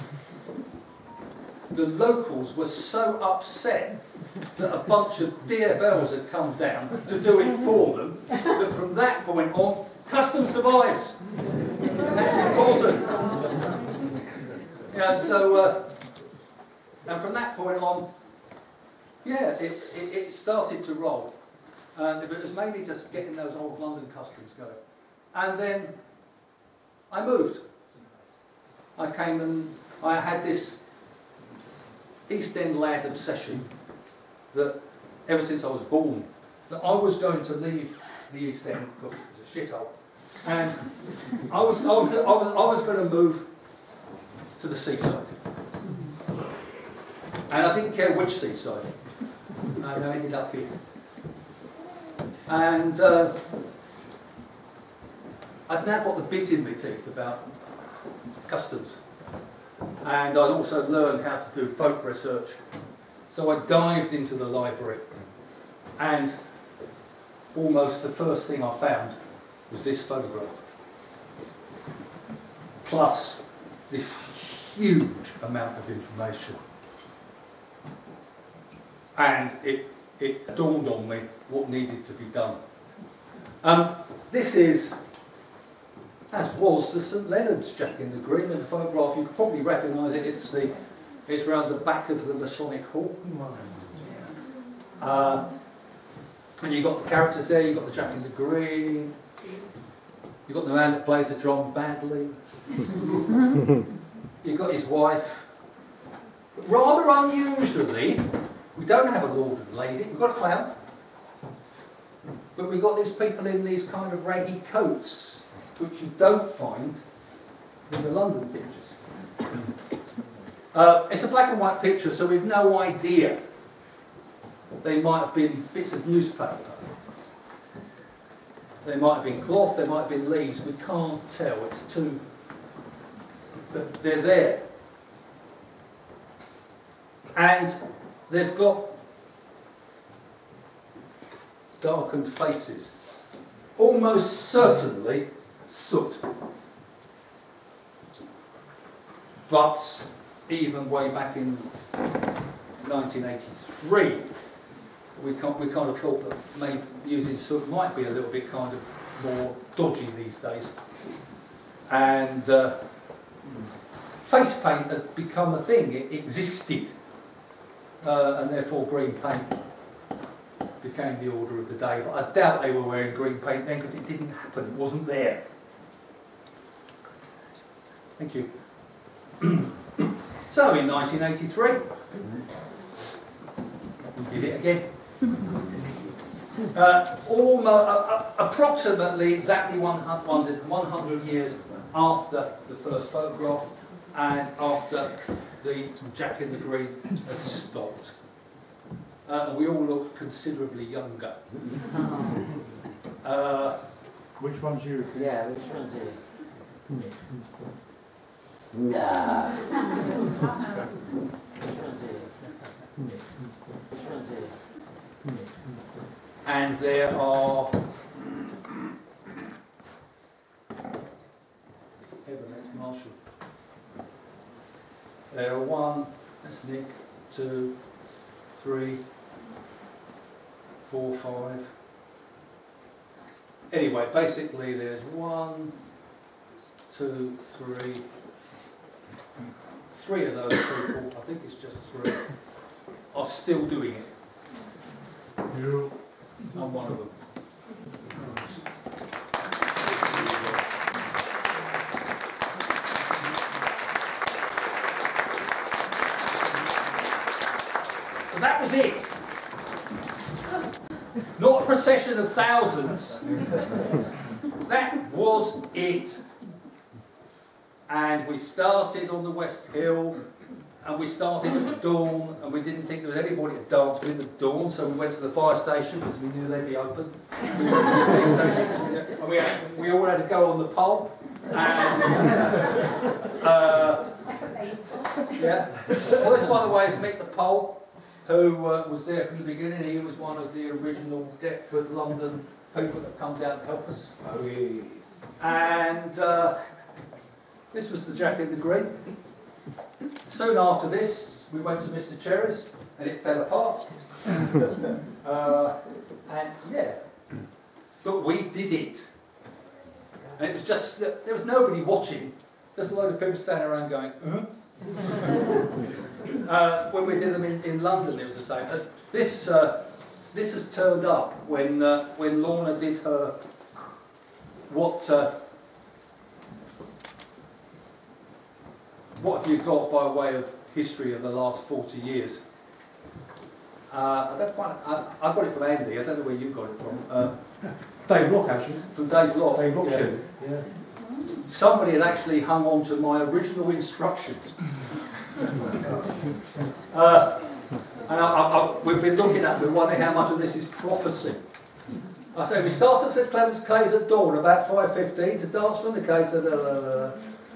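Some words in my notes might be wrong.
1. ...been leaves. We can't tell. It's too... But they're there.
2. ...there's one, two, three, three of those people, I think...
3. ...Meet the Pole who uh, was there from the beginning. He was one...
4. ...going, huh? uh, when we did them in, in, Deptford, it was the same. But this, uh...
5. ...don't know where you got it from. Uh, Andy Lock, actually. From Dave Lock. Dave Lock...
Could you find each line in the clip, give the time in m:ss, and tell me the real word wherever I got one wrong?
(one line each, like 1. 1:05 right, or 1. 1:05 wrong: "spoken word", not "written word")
1. 2:10 right
2. 3:54 right
3. 4:46 right
4. 5:13 wrong: "London", not "Deptford"
5. 5:36 wrong: "Dave", not "Andy".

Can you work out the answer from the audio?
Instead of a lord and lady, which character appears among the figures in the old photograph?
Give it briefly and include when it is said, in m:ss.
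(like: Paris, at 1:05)
A clown, at 1:50.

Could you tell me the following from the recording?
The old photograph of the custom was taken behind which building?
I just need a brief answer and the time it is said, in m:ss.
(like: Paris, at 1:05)
The Masonic Hall, at 1:32.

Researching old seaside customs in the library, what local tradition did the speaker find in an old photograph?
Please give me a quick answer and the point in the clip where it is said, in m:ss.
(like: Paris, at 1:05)
St Leonard's Jack in the Green, at 1:27.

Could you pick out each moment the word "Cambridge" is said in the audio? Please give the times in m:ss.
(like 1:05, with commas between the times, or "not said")
not said.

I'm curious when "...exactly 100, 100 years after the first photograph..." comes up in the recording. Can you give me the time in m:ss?
3:09.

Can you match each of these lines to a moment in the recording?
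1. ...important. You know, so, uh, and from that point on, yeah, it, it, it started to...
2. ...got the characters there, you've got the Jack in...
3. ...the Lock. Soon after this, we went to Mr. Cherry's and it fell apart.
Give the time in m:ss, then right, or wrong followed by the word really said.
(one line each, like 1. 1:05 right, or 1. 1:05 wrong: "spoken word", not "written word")
1. 0:12 right
2. 1:36 right
3. 4:58 wrong: "Great", not "Lock".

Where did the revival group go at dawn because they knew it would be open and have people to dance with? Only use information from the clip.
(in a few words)
The fire station.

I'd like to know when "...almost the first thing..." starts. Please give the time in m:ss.
1:07.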